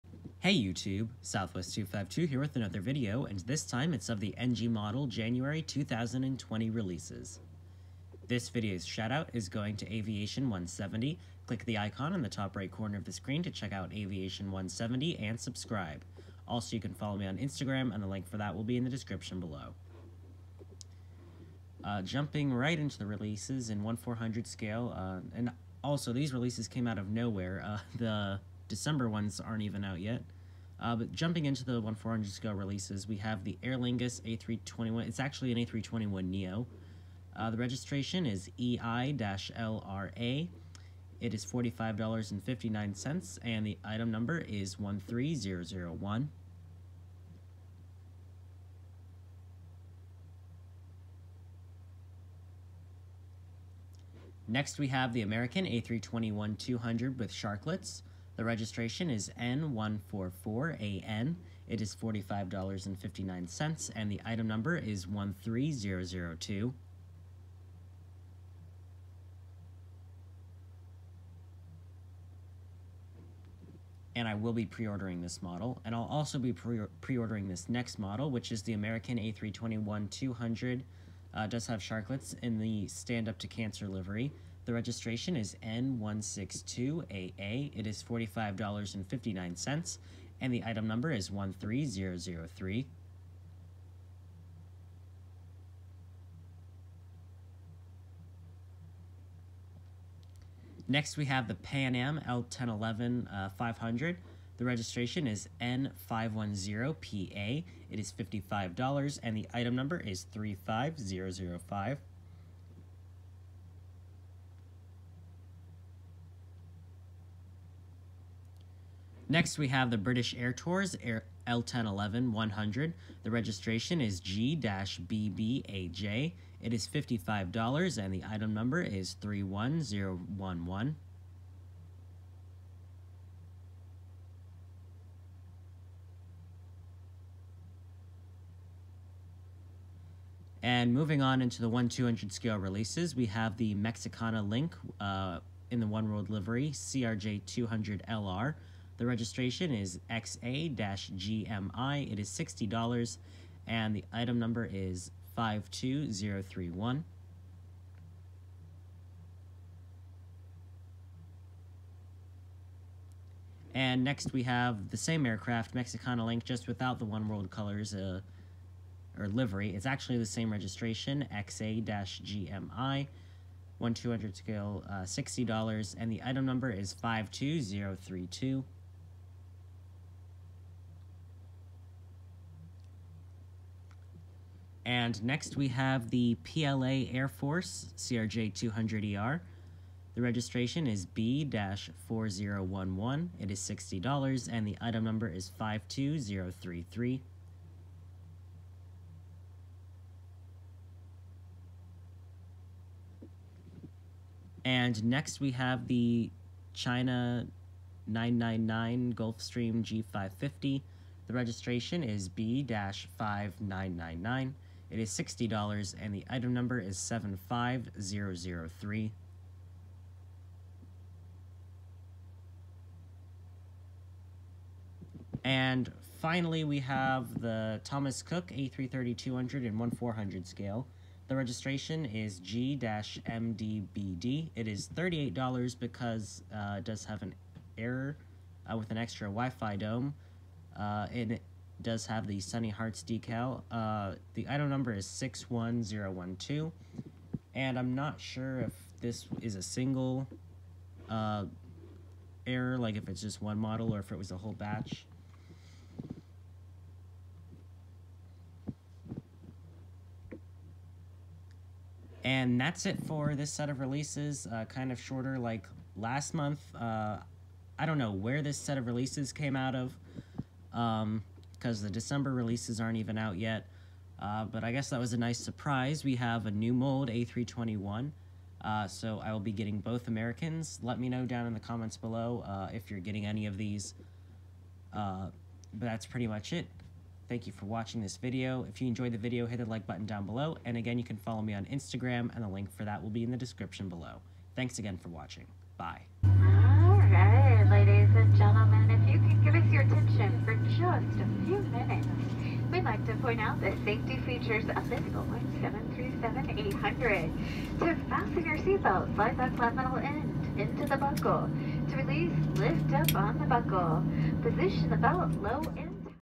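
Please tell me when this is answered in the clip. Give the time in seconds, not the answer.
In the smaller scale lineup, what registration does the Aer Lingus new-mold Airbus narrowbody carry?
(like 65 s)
38 s.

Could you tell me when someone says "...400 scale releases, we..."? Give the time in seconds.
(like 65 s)
31 s.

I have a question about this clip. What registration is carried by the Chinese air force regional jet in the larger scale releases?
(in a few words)
B-4011.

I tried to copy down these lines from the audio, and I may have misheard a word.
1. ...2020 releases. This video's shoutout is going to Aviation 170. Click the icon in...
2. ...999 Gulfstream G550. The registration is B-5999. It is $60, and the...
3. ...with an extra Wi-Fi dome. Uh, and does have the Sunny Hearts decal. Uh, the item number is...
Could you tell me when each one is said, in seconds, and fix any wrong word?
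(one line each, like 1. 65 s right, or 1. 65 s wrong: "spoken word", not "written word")
1. 5 s right
2. 208 s right
3. 238 s right.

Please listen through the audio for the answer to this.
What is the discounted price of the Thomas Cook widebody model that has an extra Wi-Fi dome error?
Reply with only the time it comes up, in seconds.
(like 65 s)
234 s.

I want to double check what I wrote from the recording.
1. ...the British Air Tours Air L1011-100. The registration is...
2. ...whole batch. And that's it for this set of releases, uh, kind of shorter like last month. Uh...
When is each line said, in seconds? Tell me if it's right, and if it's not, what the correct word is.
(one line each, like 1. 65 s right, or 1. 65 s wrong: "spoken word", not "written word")
1. 119 s right
2. 254 s right.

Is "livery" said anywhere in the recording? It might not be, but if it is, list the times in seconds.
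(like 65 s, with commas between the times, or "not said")
83 s, 146 s, 169 s.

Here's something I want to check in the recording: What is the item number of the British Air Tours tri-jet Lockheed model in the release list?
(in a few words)
31011.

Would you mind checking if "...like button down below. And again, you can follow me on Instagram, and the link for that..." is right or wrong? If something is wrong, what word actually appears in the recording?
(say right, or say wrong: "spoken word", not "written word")
right.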